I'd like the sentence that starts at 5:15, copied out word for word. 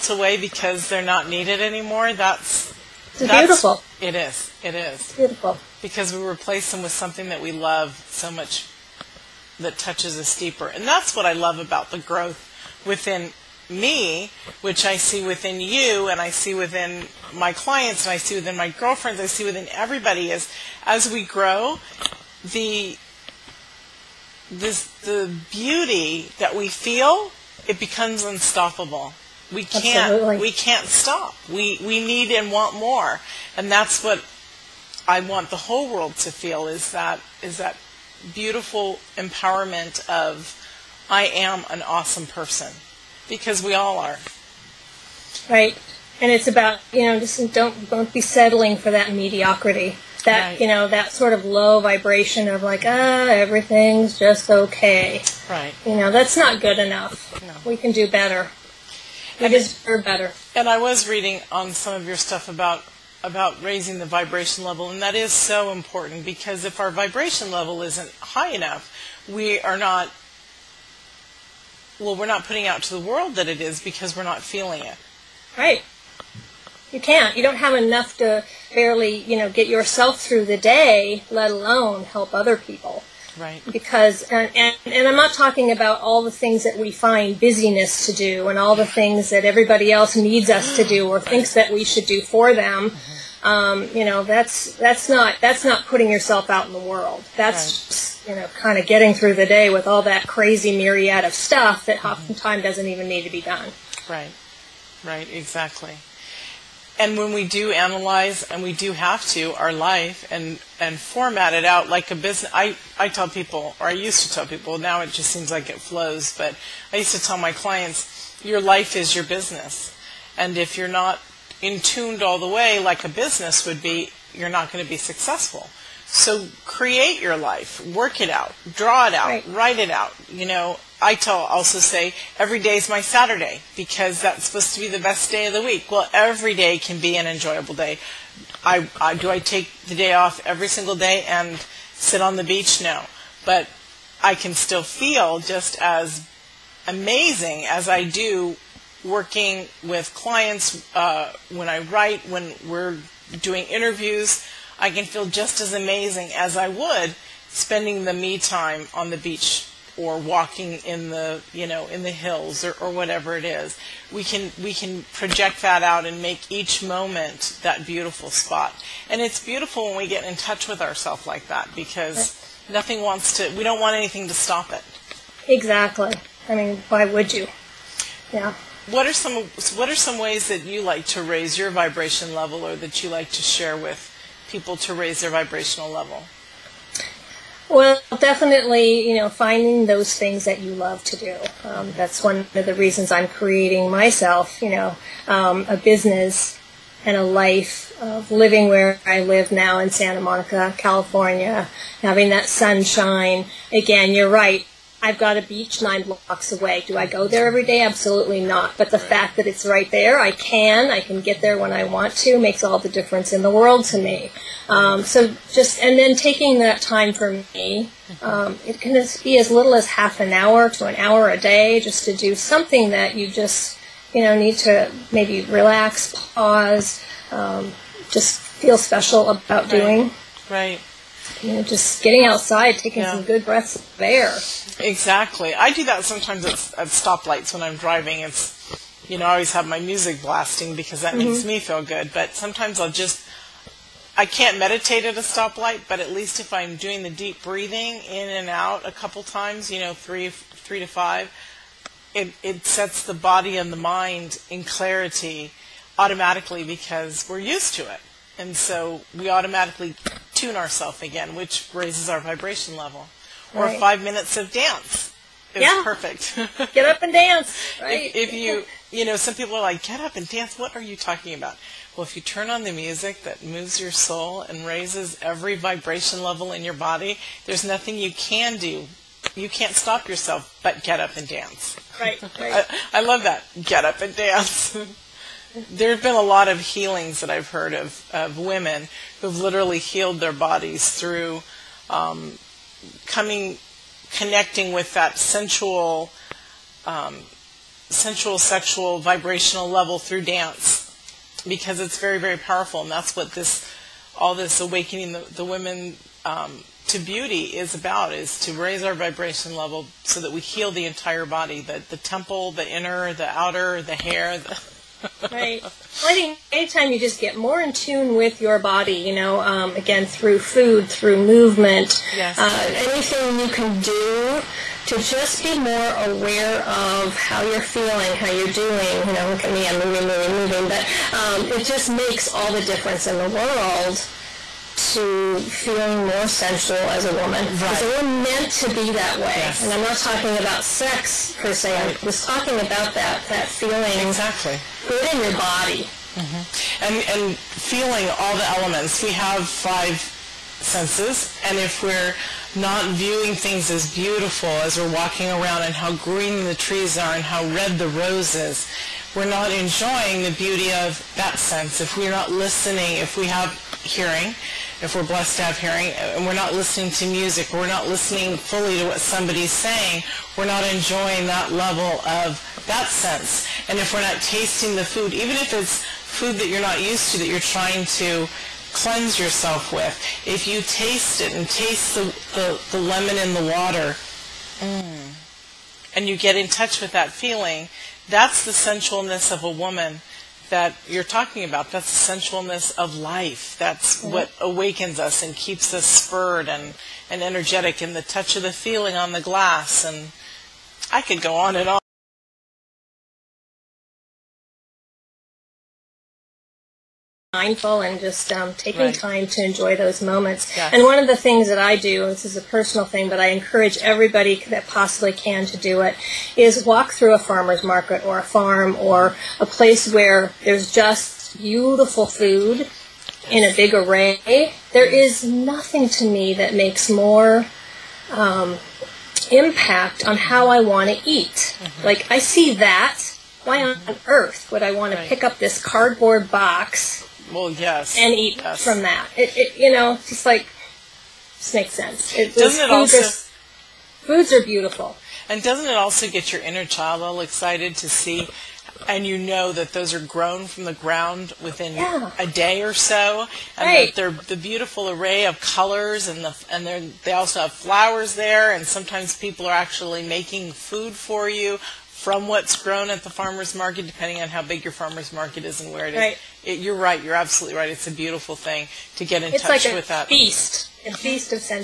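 Well, I think anytime you just get more in tune with your body, you know, um, again, through food, through movement, yes.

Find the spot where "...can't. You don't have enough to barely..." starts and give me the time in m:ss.
1:16.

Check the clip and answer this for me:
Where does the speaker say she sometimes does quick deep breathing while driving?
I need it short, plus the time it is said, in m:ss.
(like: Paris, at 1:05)
At stoplights, at 3:56.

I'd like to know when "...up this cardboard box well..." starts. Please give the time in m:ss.
7:15.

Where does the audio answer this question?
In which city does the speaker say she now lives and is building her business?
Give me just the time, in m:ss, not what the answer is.
3:19.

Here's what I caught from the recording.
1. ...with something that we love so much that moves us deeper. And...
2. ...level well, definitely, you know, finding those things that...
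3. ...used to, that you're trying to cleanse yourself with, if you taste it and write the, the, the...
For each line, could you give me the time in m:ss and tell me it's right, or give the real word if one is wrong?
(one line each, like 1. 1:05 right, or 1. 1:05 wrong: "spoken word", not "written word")
1. 0:06 wrong: "touches", not "moves"
2. 3:05 right
3. 6:16 wrong: "taste", not "write".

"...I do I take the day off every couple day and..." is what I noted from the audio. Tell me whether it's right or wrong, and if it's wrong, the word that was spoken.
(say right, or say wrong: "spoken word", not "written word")
wrong: "single", not "couple".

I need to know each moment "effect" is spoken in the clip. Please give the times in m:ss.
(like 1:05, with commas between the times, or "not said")
not said.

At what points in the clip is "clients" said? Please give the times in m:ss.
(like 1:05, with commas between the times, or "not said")
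0:17, 1:57, 2:30.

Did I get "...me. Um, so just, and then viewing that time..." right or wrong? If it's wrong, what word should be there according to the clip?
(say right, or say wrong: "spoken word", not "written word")
wrong: "taking", not "viewing".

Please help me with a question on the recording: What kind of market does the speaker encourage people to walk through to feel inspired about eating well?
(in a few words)
Farmer's market.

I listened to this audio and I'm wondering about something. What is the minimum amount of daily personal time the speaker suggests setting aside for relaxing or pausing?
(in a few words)
Half an hour.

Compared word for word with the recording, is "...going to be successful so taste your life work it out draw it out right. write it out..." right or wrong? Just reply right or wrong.
wrong.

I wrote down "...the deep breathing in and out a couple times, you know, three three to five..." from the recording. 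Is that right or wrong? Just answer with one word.
right.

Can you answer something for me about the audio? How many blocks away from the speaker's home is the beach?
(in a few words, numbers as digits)
9.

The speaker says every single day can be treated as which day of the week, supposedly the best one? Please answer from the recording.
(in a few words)
Saturday.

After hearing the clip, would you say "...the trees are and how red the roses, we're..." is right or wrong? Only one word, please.
right.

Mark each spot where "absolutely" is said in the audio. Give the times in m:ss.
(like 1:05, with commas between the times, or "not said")
0:30, 3:27, 7:47.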